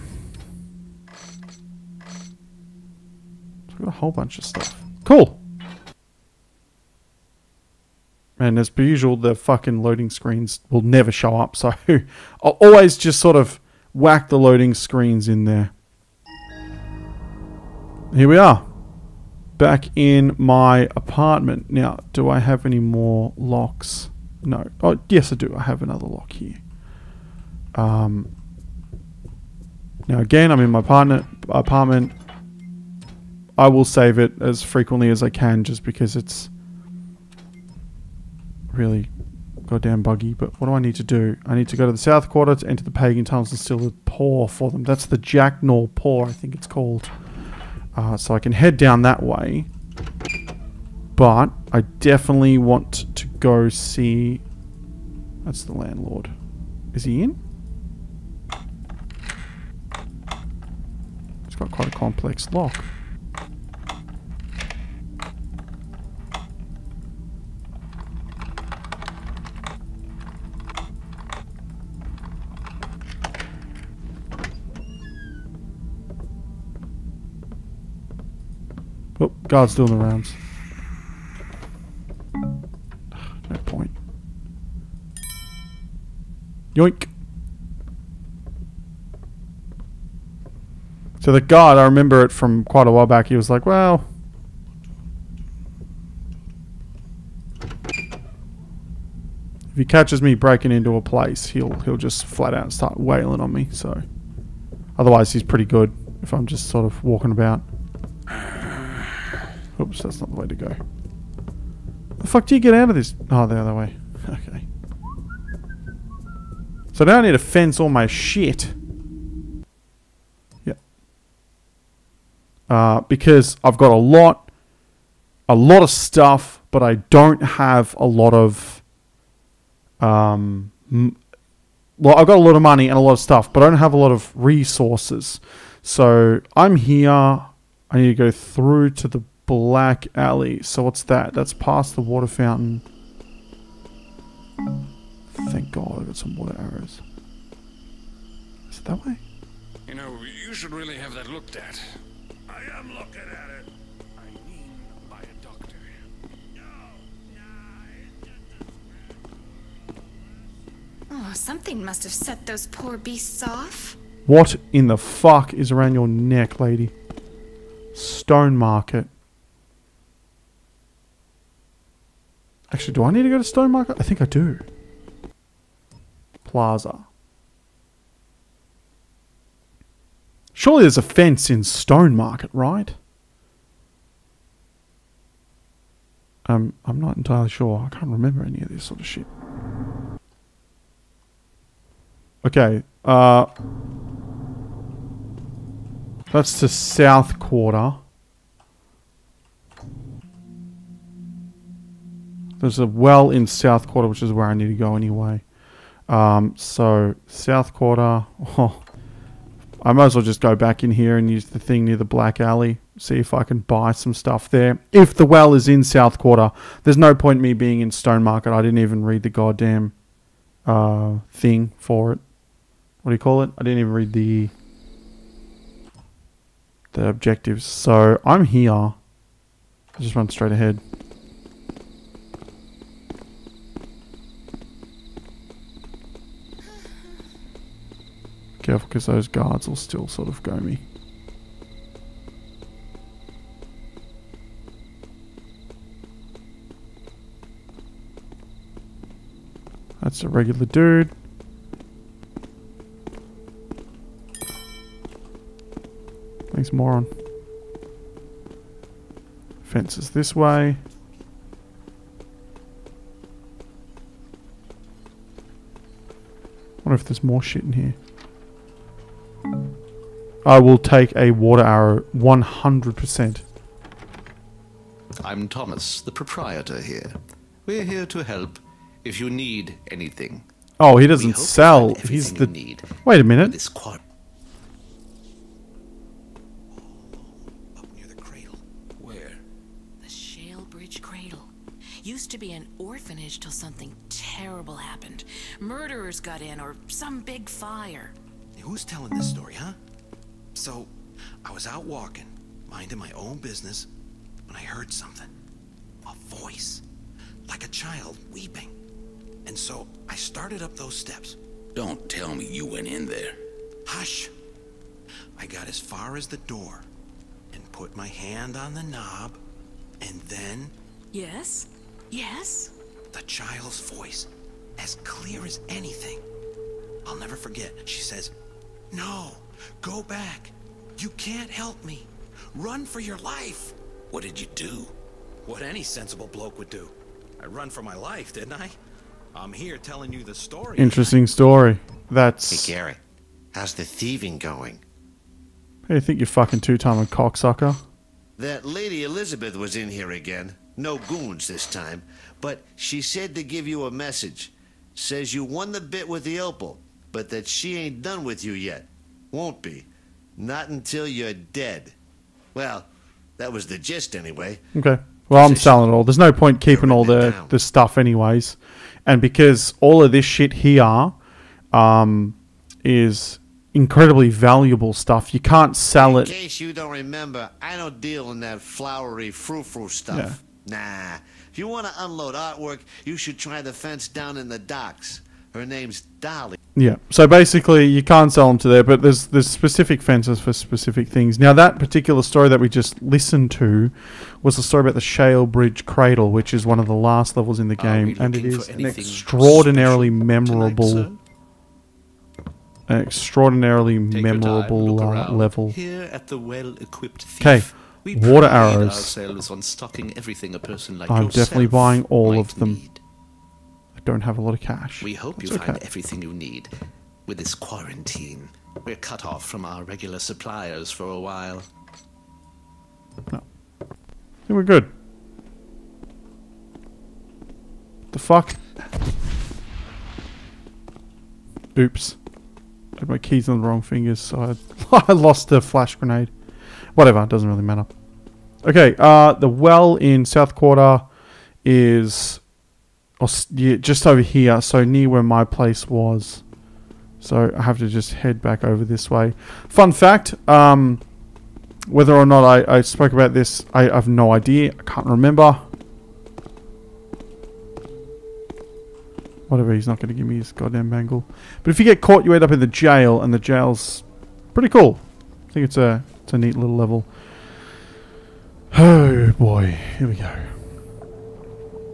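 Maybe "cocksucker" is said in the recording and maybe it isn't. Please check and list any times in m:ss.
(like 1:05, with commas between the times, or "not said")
5:46.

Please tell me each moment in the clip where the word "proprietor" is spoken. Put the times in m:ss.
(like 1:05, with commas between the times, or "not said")
4:36.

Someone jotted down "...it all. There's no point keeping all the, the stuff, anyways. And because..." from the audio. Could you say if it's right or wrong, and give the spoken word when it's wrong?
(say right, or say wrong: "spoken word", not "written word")
right.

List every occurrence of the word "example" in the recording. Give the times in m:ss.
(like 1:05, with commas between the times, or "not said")
not said.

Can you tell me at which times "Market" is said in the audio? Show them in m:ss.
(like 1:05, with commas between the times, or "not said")
2:48, 2:53, 3:02, 3:38.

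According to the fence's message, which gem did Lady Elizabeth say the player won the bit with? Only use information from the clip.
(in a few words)
Opal.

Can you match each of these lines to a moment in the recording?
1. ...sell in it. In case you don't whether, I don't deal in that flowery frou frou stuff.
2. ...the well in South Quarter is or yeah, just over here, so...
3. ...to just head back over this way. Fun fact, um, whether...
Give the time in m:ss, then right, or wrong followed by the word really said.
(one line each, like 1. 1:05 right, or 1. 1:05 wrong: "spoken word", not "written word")
1. 6:15 wrong: "remember", not "whether"
2. 7:19 right
3. 7:27 right.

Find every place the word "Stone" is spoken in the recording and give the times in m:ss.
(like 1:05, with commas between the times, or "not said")
2:47, 2:53, 3:01, 3:37.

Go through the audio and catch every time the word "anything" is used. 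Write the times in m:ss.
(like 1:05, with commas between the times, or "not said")
4:39, 5:25.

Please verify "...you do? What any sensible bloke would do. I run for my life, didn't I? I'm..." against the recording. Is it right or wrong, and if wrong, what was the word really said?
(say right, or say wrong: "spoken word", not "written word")
right.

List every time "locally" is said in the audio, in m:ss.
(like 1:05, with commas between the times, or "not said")
not said.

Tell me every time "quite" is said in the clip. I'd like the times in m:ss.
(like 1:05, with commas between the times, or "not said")
1:01, 1:32.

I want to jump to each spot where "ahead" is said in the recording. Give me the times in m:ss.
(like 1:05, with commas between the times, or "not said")
3:50.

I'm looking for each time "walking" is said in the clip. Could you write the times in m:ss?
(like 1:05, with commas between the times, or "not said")
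1:47, 5:01.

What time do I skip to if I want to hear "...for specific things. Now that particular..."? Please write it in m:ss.
6:30.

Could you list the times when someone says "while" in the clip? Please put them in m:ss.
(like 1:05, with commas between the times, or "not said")
1:32, 7:01.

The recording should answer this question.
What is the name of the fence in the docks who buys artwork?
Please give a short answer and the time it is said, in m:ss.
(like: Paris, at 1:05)
Dolly, at 6:26.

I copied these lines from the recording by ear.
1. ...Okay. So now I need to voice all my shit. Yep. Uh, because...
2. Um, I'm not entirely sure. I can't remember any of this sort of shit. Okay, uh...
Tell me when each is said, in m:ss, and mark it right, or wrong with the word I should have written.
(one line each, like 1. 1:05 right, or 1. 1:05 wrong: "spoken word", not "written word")
1. 1:54 wrong: "fence", not "voice"
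2. 3:06 right.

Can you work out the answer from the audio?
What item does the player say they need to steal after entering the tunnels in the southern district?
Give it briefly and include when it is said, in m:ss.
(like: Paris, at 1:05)
Jacknaw paw, at 0:45.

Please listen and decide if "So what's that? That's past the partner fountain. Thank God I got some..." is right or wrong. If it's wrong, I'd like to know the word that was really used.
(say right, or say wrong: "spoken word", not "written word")
wrong: "water", not "partner".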